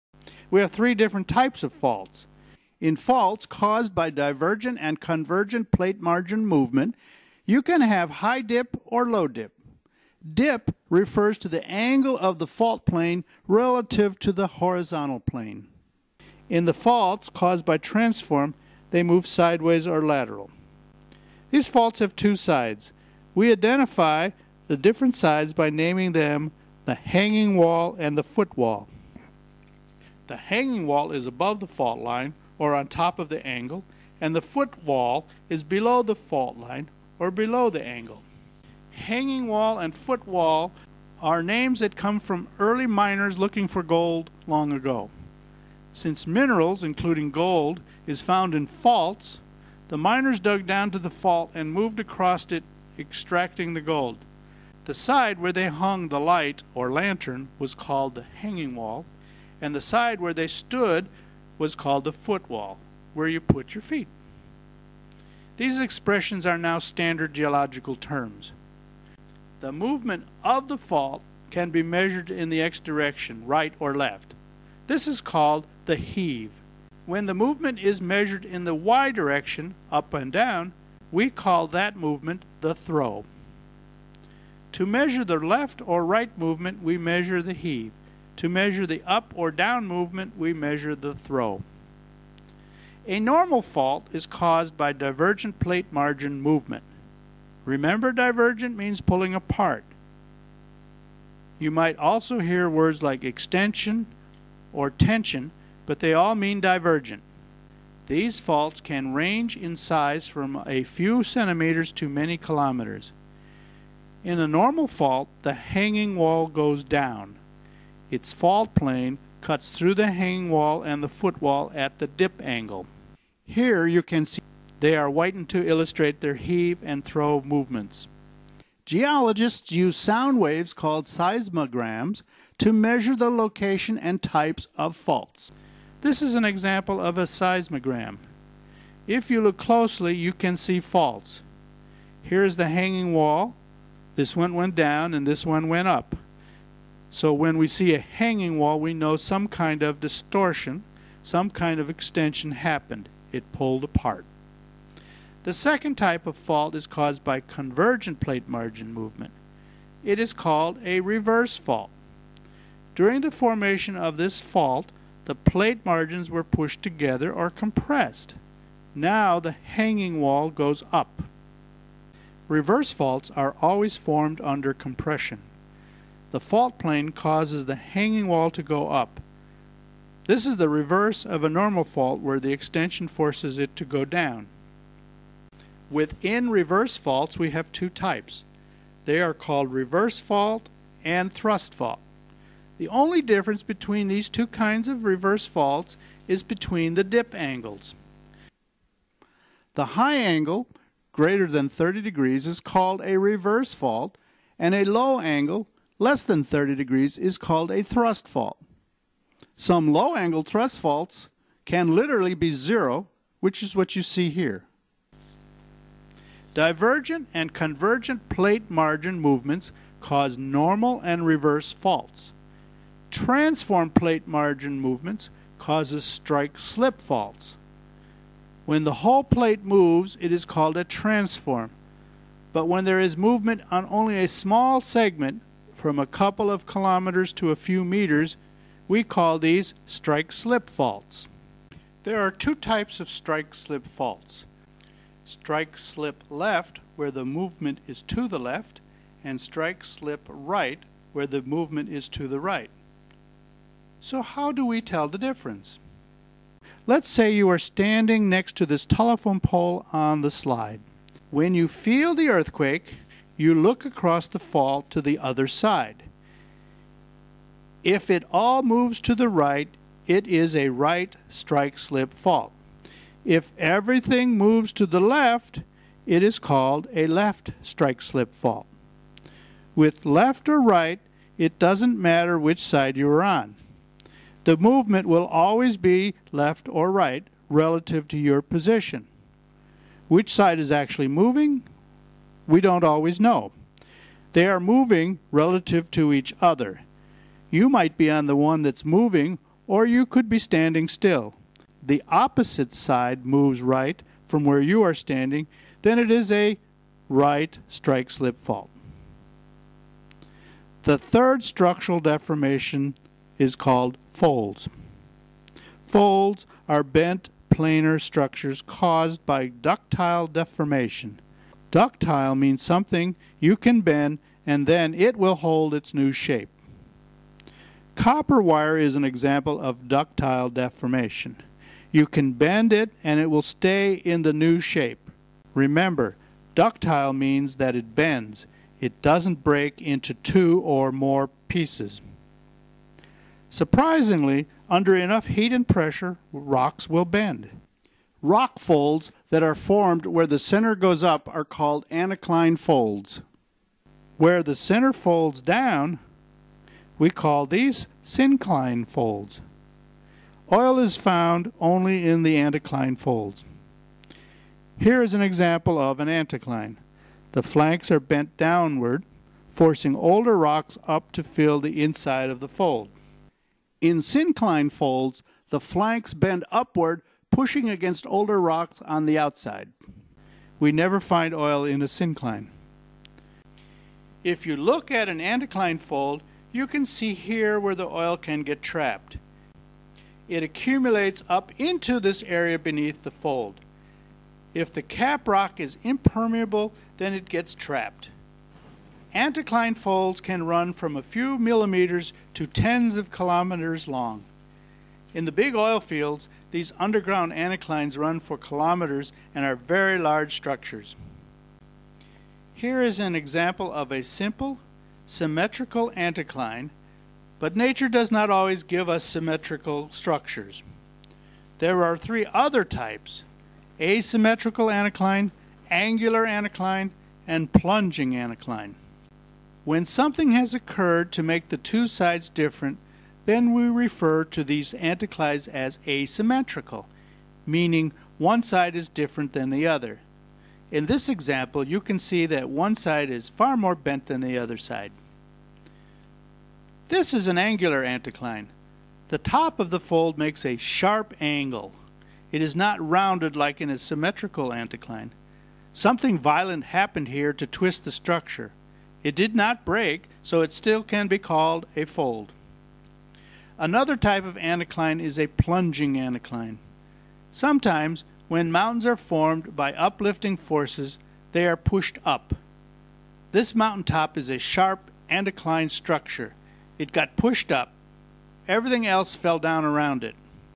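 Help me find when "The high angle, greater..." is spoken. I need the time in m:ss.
3:19.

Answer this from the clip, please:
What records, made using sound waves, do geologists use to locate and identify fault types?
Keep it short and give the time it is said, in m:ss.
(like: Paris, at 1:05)
seismograms, at 2:11.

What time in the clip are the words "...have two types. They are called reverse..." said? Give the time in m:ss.
3:07.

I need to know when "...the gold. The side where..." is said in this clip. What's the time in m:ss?
0:53.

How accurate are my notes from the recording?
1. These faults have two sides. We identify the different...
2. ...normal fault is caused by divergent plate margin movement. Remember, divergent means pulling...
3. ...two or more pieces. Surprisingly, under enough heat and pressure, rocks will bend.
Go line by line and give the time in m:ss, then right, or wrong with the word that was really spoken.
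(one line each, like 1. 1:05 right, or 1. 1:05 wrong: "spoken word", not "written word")
1. 0:21 right
2. 1:33 right
3. 5:40 right.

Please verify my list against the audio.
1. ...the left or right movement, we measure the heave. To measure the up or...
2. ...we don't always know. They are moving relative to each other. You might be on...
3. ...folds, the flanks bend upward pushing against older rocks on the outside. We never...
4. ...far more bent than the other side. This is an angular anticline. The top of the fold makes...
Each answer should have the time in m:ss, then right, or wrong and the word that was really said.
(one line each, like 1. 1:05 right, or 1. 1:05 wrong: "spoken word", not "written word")
1. 1:25 right
2. 4:52 right
3. 6:14 right
4. 7:23 right.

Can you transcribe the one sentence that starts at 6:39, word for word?
Anticline folds can run from a few millimeters to tens of kilometers long.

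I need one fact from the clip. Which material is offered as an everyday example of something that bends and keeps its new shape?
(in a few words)
copper wire.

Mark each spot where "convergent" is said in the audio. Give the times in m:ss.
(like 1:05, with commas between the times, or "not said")
0:04, 2:37, 3:37.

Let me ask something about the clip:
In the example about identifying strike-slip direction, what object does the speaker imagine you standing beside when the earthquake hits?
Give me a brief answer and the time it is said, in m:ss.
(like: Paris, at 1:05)
telephone pole, at 4:18.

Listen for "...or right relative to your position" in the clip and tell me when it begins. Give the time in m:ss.
4:46.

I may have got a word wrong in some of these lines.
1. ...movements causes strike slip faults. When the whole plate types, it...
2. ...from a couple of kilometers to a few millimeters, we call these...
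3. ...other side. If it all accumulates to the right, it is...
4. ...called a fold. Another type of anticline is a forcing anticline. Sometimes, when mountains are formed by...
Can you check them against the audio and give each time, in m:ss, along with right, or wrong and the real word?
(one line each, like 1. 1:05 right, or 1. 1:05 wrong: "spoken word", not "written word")
1. 3:44 wrong: "moves", not "types"
2. 3:55 wrong: "meters", not "millimeters"
3. 4:25 wrong: "moves", not "accumulates"
4. 7:41 wrong: "plunging", not "forcing".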